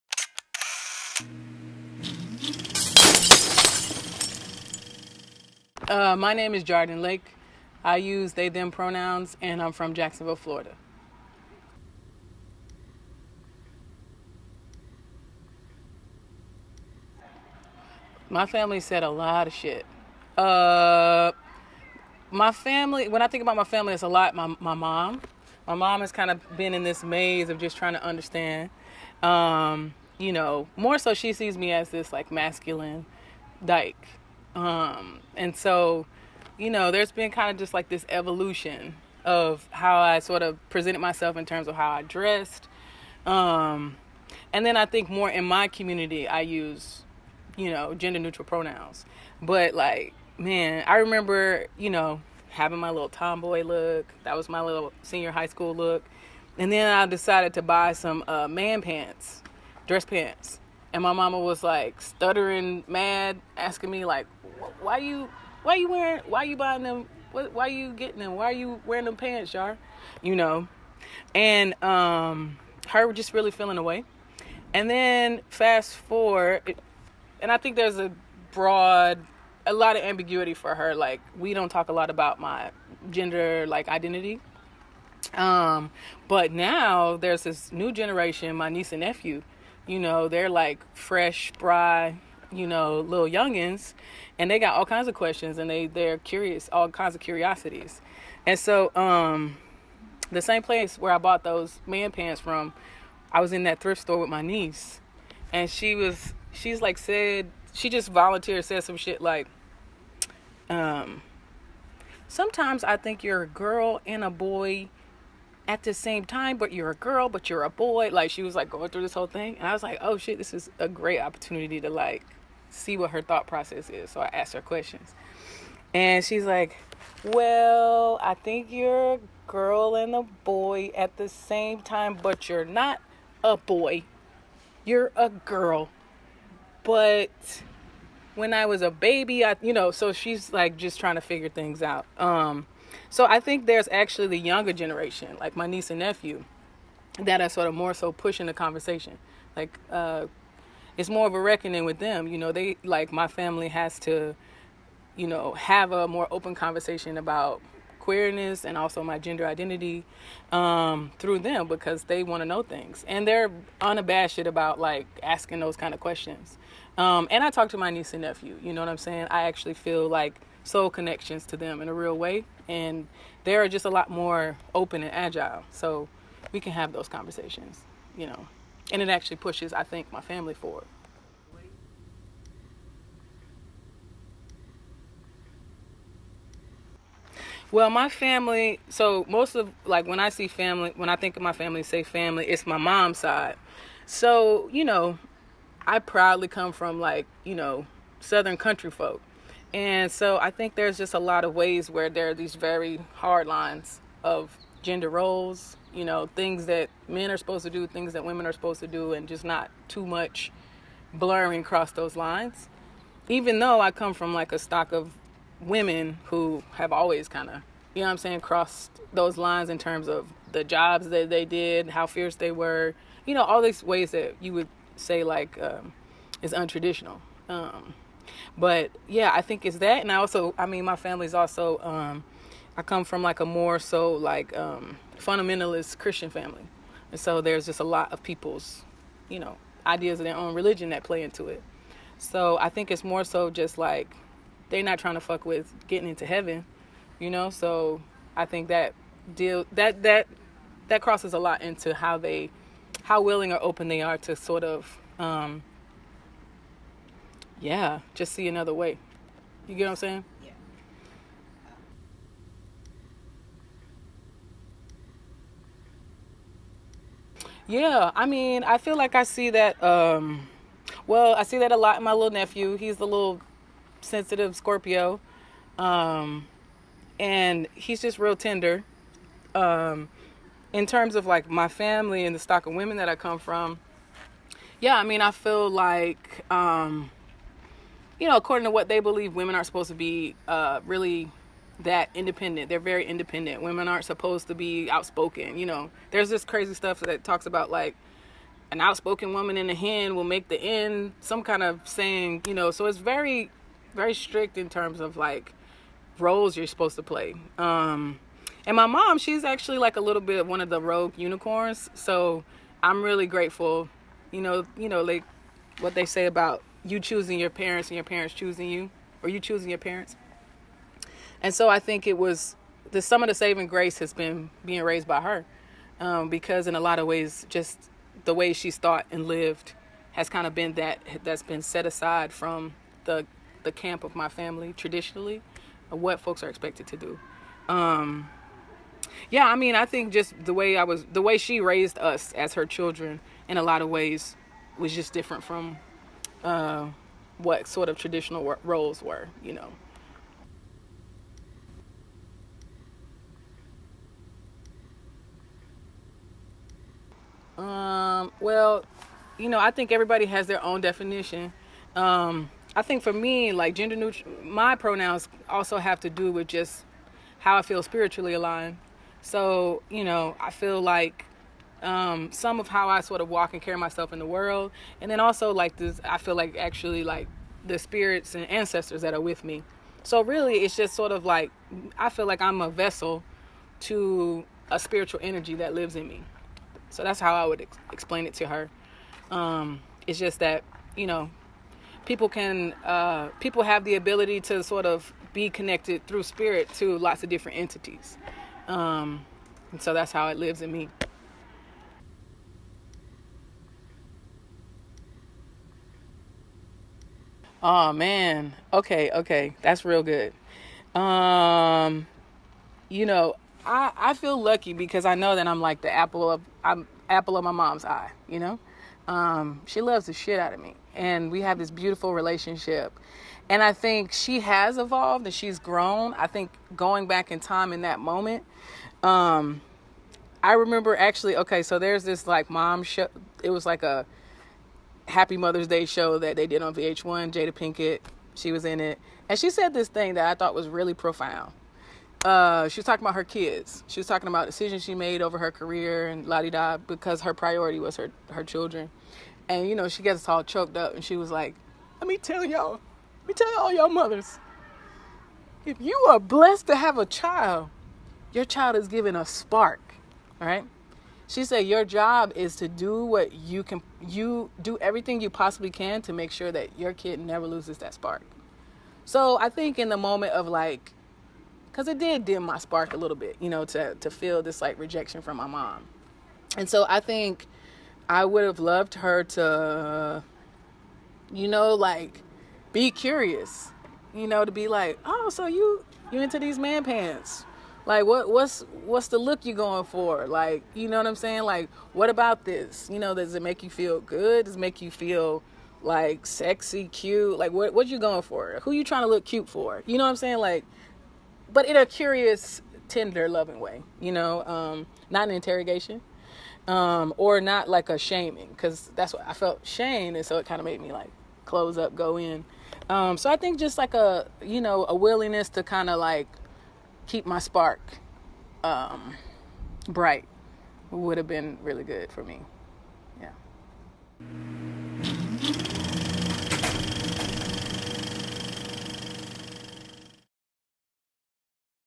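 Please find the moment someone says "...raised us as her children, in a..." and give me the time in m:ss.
5:41.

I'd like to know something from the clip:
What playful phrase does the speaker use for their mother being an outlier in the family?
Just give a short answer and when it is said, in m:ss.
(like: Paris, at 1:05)
Rogue unicorns, at 5:10.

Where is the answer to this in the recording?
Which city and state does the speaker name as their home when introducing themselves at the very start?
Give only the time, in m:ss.
0:09.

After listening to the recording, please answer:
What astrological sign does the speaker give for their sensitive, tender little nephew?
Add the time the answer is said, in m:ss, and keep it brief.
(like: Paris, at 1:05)
Scorpio, at 4:34.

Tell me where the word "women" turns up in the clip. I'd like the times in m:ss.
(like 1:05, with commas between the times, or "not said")
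3:28, 3:35, 4:42, 4:49, 4:53.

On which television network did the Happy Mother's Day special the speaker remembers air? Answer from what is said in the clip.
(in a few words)
VH1.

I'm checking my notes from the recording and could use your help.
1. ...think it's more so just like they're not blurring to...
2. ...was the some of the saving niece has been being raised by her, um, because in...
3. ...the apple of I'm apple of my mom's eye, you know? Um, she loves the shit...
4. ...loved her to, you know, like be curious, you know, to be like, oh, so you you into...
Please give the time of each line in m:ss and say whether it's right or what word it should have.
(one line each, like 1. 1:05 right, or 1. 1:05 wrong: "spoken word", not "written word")
1. 4:02 wrong: "trying", not "blurring"
2. 5:22 wrong: "grace", not "niece"
3. 6:55 right
4. 7:58 right.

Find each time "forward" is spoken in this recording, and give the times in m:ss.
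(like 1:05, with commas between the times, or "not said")
1:15, 3:00.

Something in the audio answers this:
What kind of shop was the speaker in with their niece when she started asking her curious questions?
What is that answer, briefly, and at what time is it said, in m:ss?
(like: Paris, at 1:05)
Thrift store, at 1:43.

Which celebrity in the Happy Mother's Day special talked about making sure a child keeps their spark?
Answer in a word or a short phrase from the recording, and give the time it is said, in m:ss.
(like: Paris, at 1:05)
Jada Pinkett, at 7:17.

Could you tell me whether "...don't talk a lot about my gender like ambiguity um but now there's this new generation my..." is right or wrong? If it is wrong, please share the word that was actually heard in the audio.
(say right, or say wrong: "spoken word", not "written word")
wrong: "identity", not "ambiguity".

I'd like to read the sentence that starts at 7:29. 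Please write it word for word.
And you know, she gets all choked up and she was like, Let me tell y'all, let me tell all y'all mothers.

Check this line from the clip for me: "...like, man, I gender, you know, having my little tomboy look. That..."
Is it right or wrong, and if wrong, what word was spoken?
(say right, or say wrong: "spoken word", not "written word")
wrong: "remember", not "gender".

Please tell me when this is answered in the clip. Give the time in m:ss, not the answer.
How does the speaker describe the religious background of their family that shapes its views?
3:55.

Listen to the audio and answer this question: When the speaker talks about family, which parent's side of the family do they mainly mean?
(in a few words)
Mom's side.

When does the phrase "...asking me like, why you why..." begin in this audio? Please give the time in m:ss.
1:03.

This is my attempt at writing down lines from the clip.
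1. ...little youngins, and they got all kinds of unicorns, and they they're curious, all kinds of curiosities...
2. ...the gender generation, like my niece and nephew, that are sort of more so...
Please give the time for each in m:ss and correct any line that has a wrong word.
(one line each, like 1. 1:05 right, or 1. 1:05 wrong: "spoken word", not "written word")
1. 1:32 wrong: "questions", not "unicorns"
2. 2:24 wrong: "younger", not "gender".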